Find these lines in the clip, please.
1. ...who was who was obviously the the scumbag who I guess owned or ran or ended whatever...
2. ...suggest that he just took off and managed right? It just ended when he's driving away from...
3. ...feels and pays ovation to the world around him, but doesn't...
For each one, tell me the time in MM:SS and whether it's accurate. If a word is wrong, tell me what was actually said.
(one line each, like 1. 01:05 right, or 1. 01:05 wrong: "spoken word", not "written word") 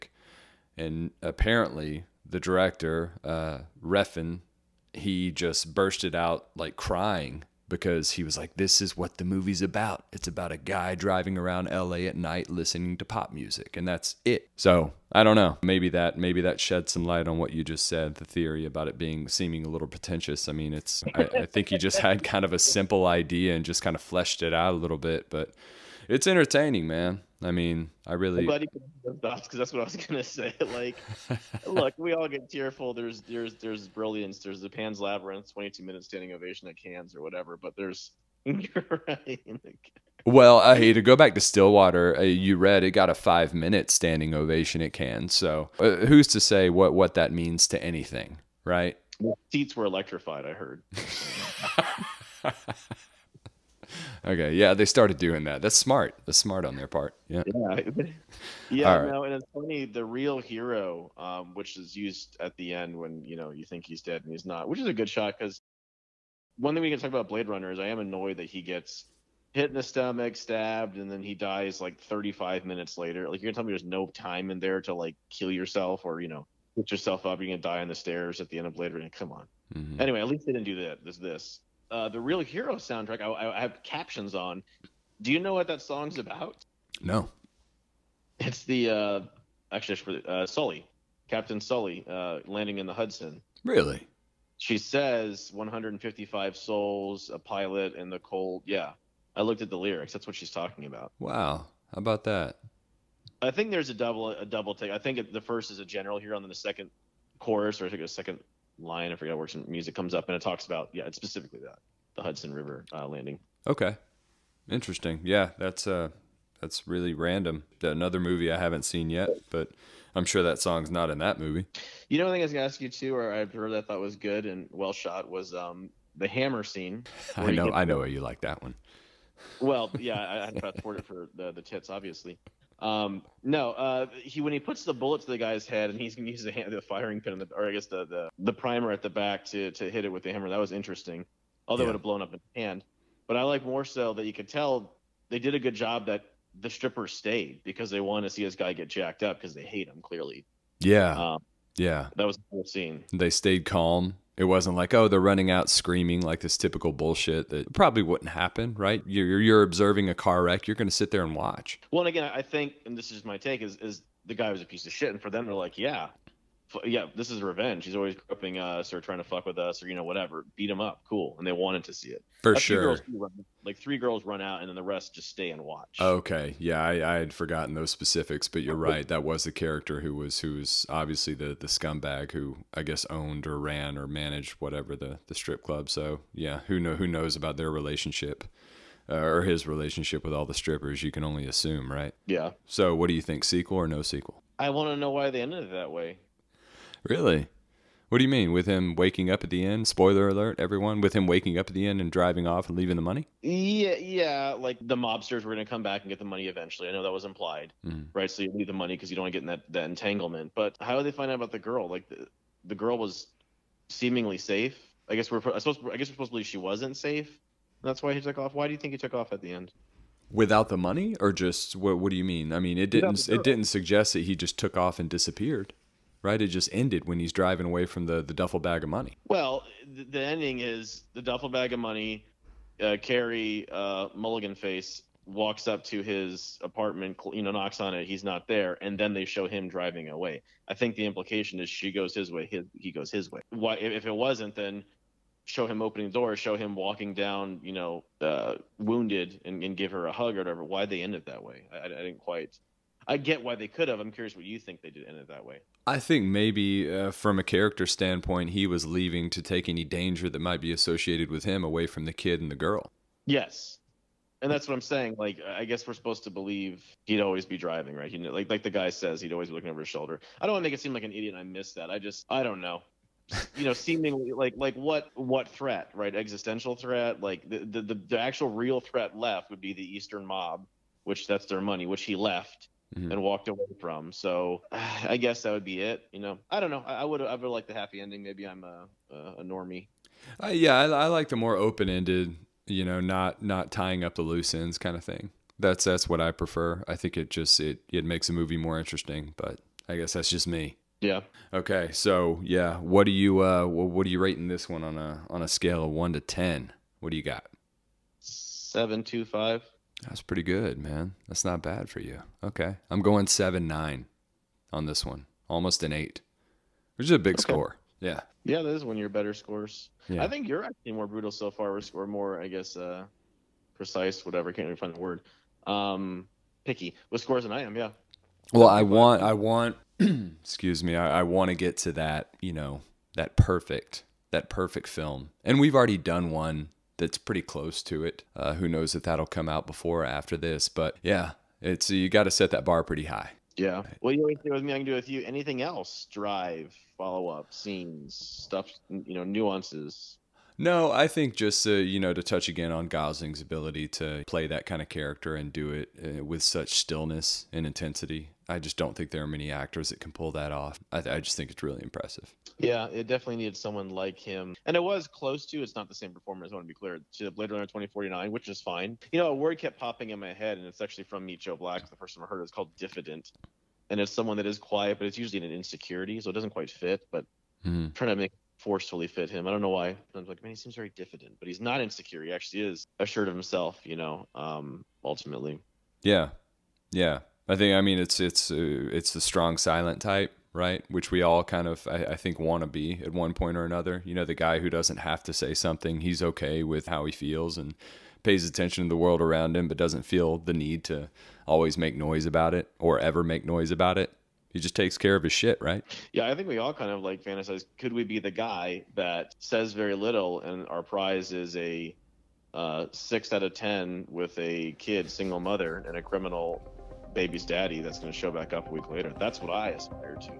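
1. 03:00 wrong: "managed", not "ended"
2. 03:43 wrong: "disappeared", not "managed"
3. 06:37 wrong: "attention", not "ovation".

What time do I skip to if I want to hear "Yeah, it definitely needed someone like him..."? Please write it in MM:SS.
06:02.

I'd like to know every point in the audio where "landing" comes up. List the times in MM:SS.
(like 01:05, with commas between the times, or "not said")
01:32, 01:53.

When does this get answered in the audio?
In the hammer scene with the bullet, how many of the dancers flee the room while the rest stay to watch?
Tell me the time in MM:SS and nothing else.
02:53.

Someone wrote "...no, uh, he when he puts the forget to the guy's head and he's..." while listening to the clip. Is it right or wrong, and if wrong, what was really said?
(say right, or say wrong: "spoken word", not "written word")
wrong: "bullet", not "forget".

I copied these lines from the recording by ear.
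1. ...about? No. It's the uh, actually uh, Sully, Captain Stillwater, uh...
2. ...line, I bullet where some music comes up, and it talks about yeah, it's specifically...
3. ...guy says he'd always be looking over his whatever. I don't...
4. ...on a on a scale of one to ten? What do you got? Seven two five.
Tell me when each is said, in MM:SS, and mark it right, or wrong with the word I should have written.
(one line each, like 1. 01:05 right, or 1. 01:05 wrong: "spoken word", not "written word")
1. 01:26 wrong: "Sully", not "Stillwater"
2. 01:48 wrong: "forget", not "bullet"
3. 04:28 wrong: "shoulder", not "whatever"
4. 05:04 right.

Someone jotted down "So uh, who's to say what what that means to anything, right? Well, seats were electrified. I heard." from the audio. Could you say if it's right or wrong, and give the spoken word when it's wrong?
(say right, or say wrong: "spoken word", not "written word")
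right.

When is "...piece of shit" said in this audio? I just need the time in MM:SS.
02:44.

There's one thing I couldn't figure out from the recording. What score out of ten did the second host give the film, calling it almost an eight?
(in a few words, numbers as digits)
7.9.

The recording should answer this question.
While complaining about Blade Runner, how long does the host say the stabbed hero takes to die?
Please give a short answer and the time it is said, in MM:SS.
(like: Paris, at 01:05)
35 minutes, at 01:11.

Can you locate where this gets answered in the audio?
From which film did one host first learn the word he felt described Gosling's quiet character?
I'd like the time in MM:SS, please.
06:11.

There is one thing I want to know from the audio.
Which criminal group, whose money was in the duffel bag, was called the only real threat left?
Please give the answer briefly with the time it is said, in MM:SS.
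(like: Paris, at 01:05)
Eastern mob, at 04:39.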